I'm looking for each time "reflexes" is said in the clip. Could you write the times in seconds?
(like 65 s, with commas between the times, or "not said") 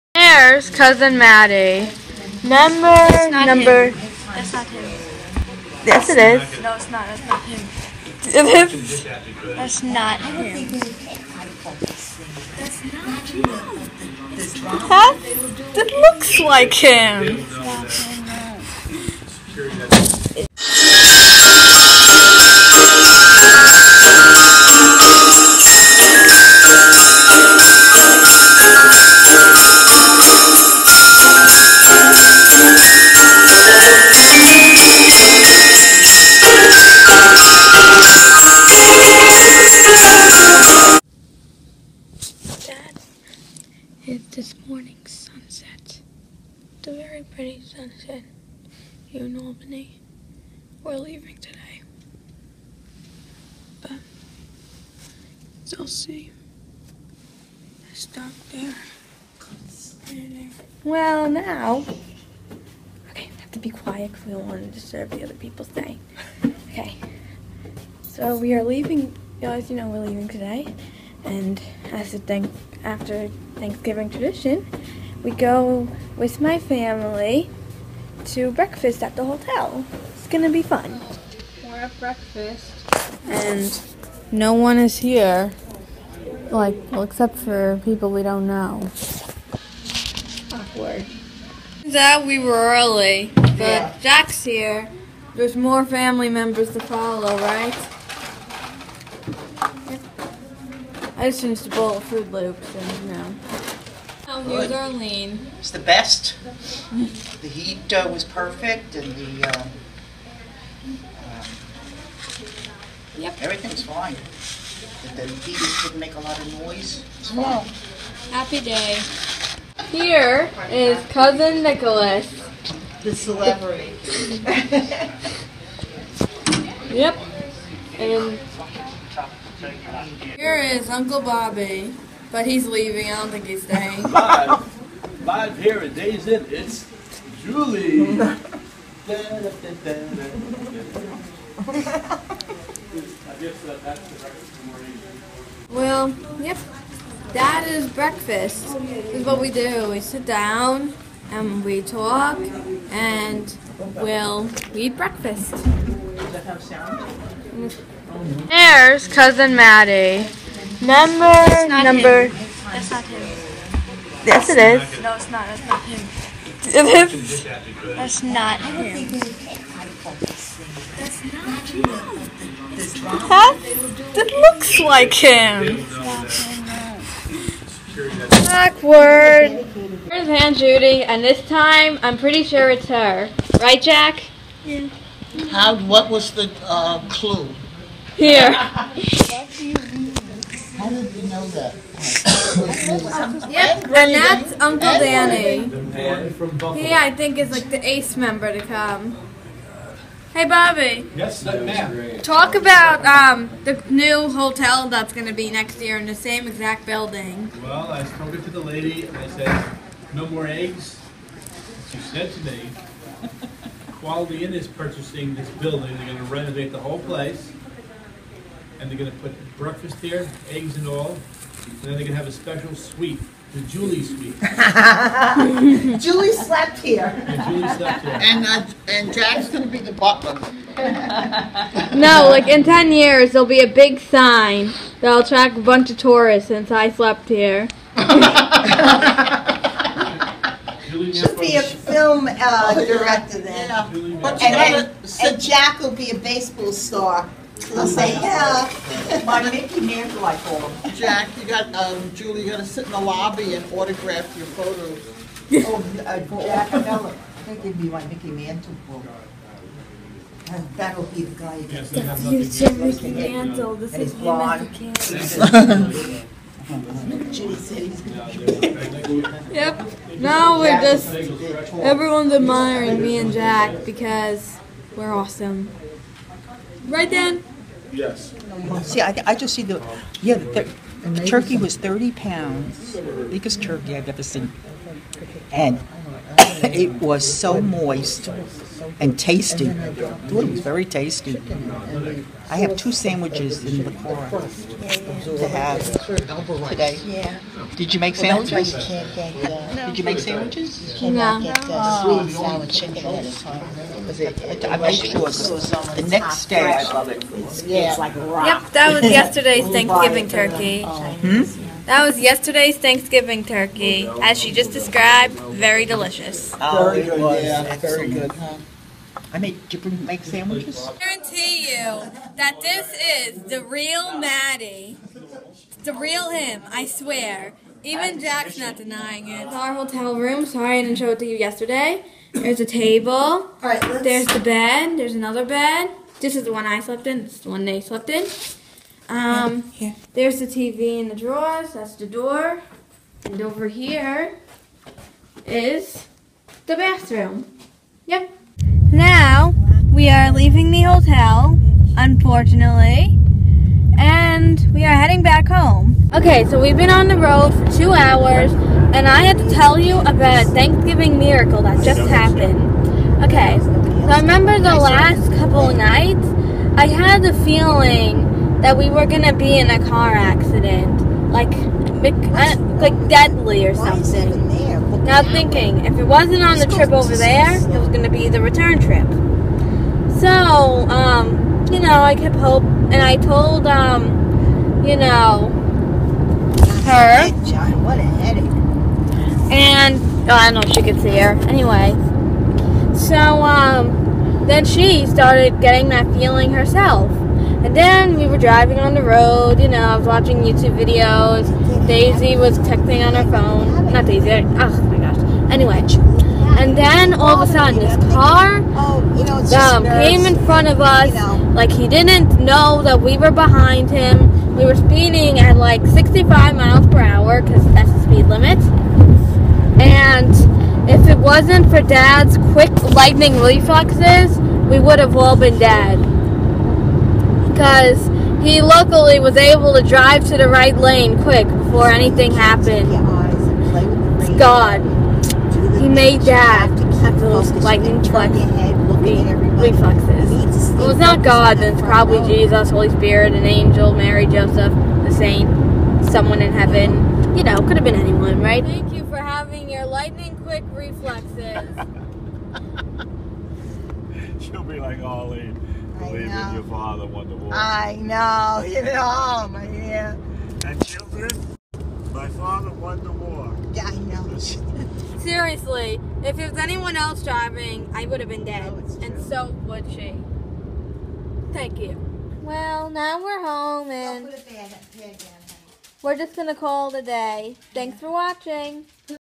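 423 s, 439 s, 450 s.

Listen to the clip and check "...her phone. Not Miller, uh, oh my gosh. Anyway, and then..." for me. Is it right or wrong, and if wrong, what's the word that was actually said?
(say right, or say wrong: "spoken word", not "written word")
wrong: "Daisy", not "Miller".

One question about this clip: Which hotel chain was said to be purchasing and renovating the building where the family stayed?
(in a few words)
Quality Inn.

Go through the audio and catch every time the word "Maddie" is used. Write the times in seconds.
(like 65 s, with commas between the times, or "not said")
1 s, 159 s, 324 s.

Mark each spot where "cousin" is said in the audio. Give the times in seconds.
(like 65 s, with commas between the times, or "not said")
0 s, 121 s, 159 s.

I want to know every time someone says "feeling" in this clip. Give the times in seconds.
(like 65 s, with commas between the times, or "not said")
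367 s, 396 s.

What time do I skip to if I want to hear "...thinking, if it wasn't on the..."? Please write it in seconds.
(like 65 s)
375 s.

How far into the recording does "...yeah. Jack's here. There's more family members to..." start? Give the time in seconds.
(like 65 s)
93 s.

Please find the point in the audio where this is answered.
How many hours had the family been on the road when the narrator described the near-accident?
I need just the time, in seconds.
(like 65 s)
357 s.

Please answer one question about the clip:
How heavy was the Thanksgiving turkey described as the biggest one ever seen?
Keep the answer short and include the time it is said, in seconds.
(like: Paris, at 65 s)
30 pounds, at 281 s.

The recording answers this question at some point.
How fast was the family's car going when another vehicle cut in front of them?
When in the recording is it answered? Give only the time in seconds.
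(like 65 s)
415 s.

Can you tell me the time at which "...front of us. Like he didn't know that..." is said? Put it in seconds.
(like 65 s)
410 s.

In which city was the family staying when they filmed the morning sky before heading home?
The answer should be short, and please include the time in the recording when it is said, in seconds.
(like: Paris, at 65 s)
Albany, at 49 s.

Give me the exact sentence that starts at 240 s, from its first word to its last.
she Should be a film uh, oh, director then.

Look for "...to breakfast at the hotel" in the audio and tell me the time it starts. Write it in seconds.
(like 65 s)
78 s.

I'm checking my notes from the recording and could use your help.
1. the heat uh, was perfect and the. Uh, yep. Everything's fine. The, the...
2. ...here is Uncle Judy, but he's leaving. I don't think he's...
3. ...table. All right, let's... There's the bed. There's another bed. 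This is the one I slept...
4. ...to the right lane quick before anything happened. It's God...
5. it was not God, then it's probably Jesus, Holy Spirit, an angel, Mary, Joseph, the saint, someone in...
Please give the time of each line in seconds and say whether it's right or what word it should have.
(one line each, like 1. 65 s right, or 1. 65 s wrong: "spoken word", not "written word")
1. 106 s right
2. 130 s wrong: "Bobby", not "Judy"
3. 332 s right
4. 430 s right
5. 440 s right.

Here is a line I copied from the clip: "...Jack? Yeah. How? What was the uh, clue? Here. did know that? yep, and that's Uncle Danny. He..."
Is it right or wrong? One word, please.
right.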